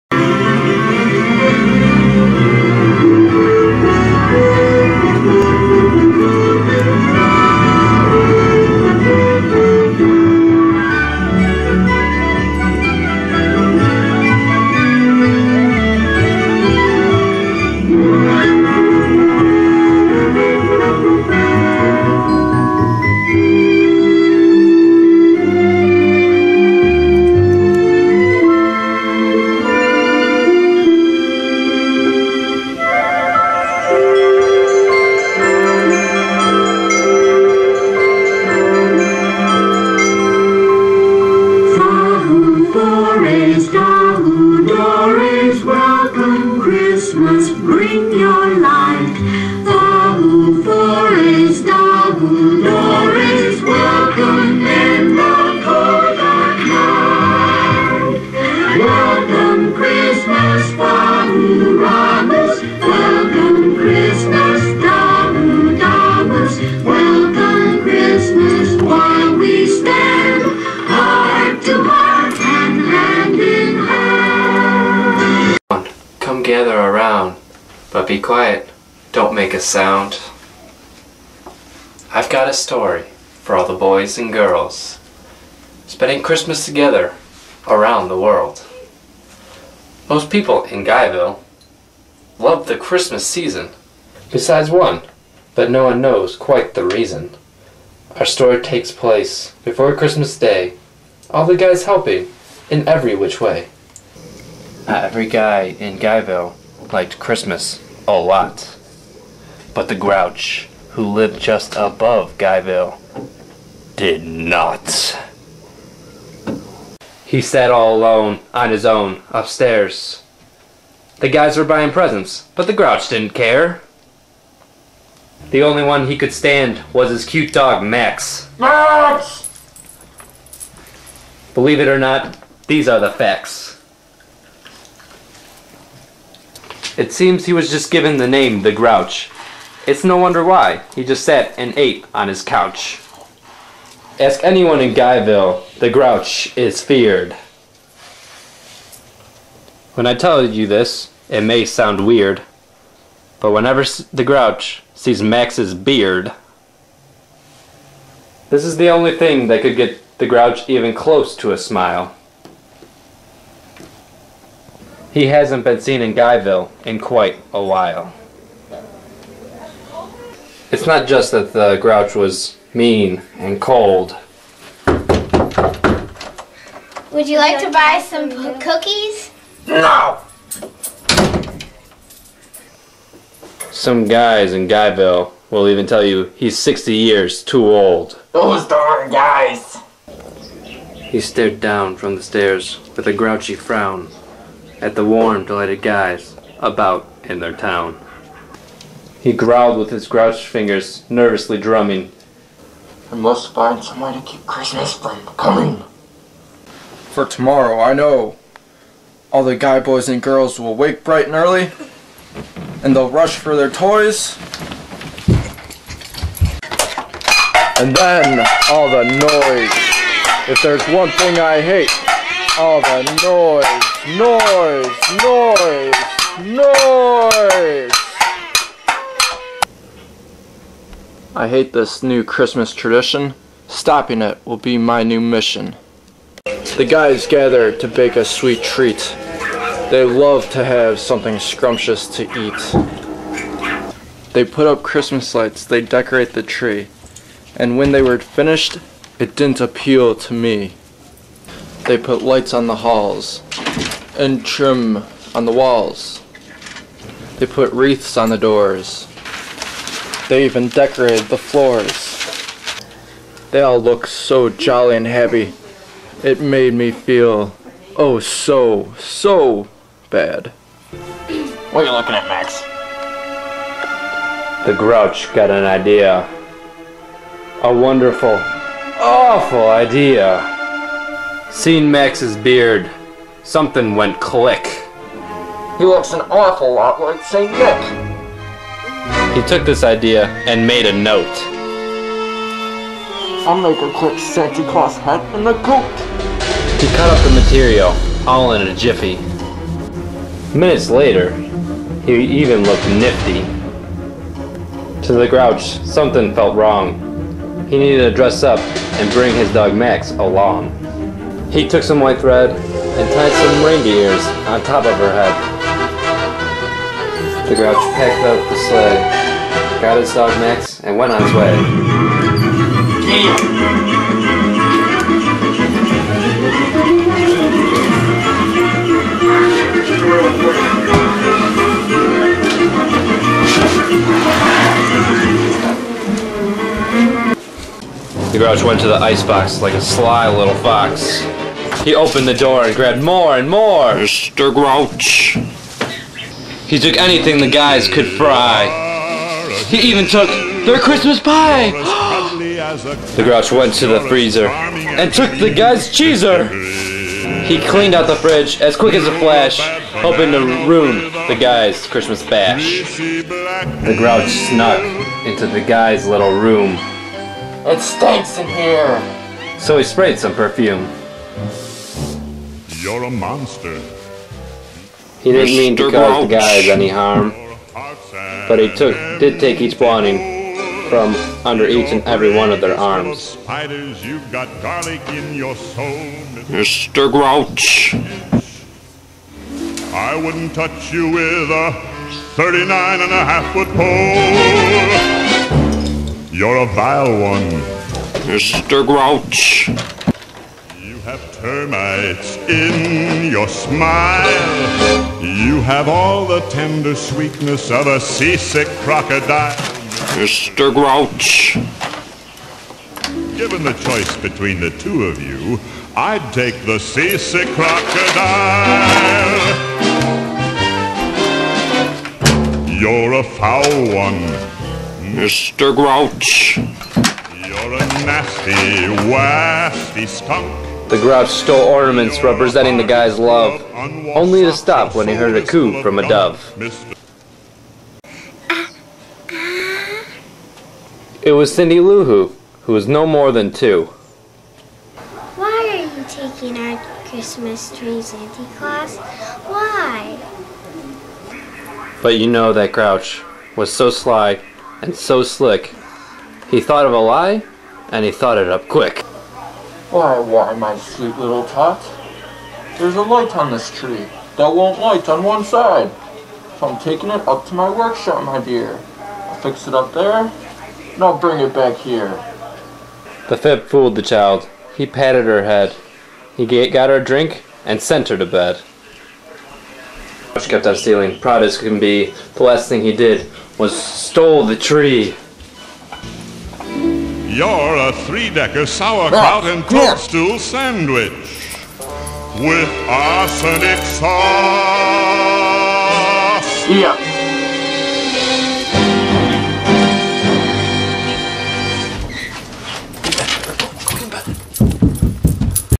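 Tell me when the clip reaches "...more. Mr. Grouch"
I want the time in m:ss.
5:43.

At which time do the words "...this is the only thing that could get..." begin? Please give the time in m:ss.
2:38.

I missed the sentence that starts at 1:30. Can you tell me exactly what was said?
Most people in Guyville love the Christmas season, besides one, but no one knows quite the reason.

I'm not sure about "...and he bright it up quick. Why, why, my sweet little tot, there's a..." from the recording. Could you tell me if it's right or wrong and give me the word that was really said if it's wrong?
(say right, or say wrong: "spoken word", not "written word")
wrong: "thought", not "bright".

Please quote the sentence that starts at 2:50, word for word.
It's not just that the grouch was mean and cold.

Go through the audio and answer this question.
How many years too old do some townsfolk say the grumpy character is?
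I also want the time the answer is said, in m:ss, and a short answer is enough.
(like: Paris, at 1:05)
60, at 3:06.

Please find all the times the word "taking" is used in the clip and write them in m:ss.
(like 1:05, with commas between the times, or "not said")
7:26, 7:46.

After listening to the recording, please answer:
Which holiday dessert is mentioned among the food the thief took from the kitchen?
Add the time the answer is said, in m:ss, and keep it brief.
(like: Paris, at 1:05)
Christmas pie, at 5:50.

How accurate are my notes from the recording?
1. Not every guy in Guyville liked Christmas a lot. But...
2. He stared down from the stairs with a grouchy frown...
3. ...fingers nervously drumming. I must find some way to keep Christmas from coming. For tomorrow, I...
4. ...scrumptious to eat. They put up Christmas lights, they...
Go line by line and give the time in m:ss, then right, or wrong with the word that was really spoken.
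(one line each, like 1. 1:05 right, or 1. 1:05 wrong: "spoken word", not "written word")
1. 1:44 right
2. 3:10 right
3. 3:20 right
4. 4:01 right.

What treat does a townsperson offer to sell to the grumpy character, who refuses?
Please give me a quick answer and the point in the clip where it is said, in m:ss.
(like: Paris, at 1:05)
cookies, at 2:57.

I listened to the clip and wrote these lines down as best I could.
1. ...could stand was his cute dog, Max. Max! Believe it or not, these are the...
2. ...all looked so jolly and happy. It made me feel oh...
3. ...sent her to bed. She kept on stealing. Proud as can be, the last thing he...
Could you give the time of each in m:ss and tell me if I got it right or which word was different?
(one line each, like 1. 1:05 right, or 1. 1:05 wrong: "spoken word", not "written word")
1. 2:06 right
2. 4:23 right
3. 7:57 right.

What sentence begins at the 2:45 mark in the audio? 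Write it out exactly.
He hasn't been seen in Guyville in quite a while.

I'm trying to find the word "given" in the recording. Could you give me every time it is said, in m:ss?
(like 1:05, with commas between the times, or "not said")
2:17, 6:53.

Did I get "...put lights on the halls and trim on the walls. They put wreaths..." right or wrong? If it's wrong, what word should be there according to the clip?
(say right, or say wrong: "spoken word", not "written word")
right.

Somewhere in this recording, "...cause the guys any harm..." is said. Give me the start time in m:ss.
6:15.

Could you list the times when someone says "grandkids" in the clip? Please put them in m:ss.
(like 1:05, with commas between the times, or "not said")
not said.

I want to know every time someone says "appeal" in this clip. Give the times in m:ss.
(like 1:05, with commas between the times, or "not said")
4:09.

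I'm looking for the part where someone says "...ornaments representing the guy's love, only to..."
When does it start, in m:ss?
7:11.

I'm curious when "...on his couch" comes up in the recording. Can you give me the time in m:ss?
2:22.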